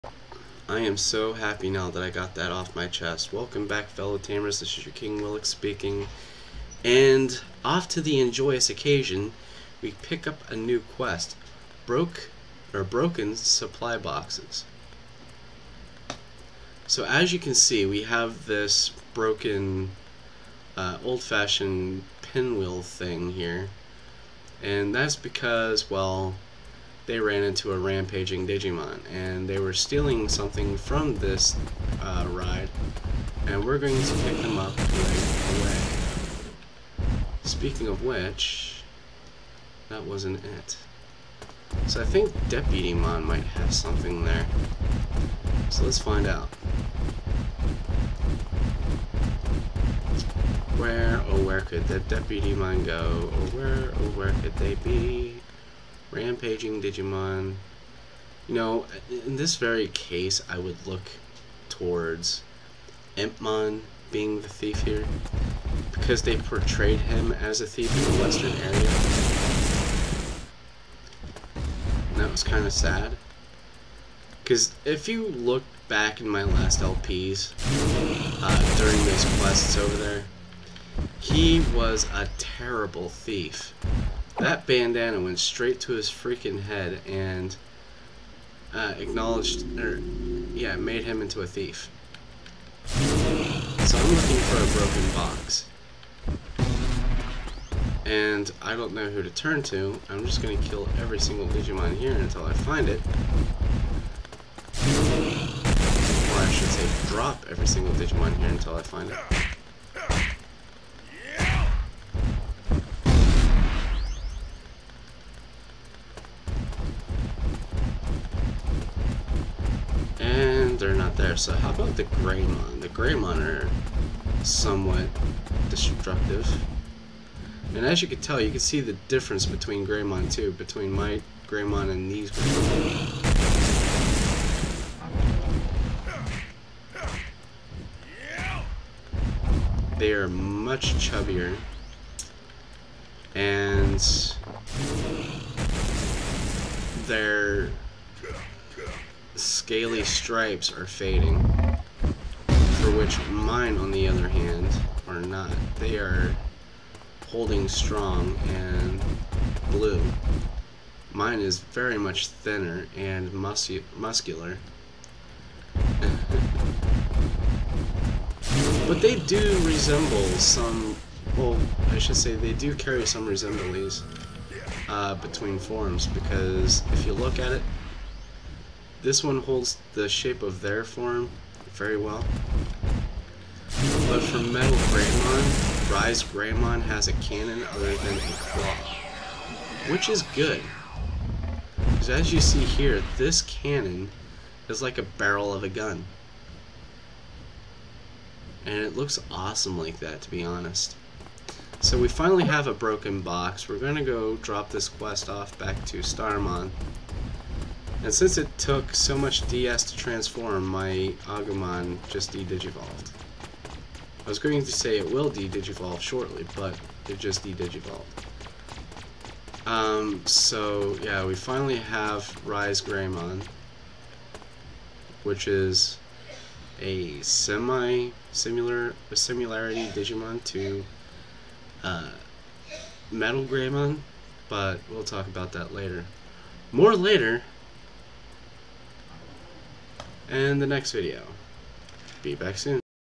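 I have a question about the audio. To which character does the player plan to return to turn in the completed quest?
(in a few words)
Starmon.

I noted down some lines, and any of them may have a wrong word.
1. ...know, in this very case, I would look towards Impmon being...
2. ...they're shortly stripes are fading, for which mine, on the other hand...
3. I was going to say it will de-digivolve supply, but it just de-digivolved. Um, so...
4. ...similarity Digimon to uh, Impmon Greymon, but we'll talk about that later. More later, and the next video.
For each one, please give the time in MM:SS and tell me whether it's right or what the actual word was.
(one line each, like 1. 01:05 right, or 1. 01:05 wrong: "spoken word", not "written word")
1. 00:58 right
2. 02:27 wrong: "daily", not "shortly"
3. 03:34 wrong: "shortly", not "supply"
4. 03:49 wrong: "Metal", not "Impmon".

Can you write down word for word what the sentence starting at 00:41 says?
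So I think Deputymon might have something there.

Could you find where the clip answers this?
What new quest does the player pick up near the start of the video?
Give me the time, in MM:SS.
00:11.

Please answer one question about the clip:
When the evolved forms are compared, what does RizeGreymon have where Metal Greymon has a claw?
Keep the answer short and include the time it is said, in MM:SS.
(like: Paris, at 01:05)
A cannon, at 03:07.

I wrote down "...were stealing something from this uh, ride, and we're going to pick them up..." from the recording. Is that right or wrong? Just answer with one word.
right.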